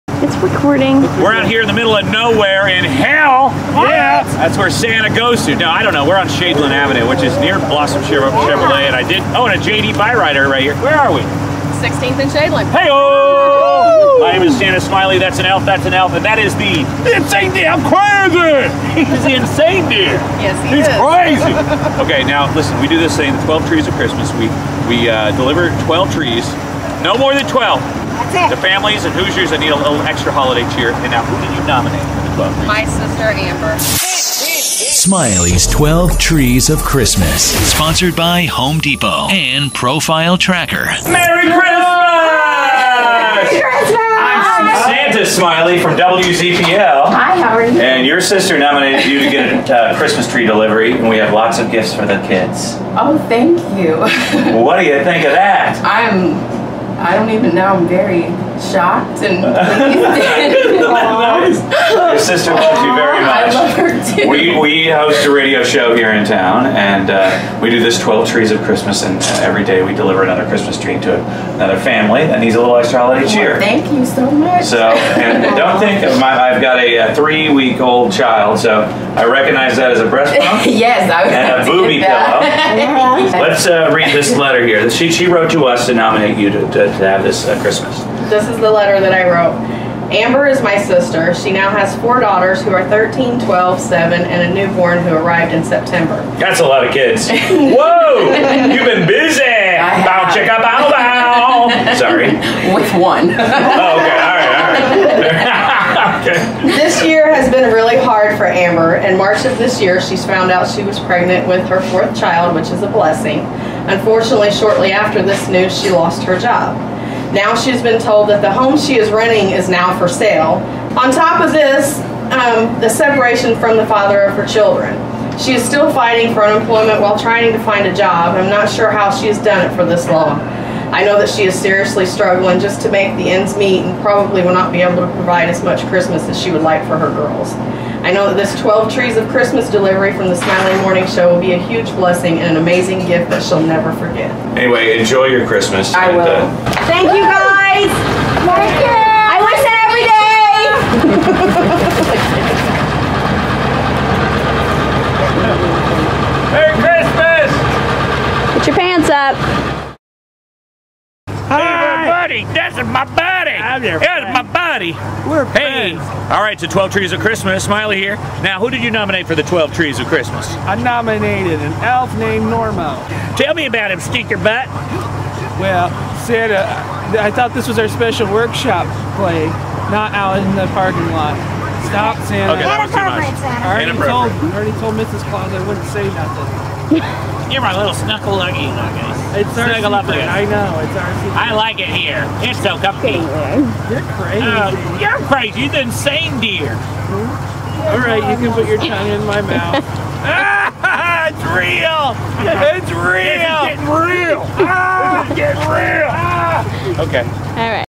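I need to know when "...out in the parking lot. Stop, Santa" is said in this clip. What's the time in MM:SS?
03:00.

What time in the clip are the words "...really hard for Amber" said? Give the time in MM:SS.
01:47.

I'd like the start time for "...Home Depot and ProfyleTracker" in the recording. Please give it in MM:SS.
00:38.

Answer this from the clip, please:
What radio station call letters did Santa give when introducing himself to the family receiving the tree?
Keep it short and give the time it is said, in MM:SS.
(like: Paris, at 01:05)
WZPL, at 00:45.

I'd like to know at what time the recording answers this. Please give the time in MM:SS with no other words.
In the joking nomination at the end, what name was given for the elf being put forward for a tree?
02:52.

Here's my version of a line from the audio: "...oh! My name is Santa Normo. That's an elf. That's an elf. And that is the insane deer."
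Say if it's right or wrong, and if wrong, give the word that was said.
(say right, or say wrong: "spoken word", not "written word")
wrong: "Smiley", not "Normo".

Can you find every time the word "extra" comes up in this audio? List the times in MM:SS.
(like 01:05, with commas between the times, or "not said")
00:30, 01:12.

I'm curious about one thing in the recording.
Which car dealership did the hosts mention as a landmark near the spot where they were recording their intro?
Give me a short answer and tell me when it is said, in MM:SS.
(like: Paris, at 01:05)
Blossom Chevrolet, at 00:07.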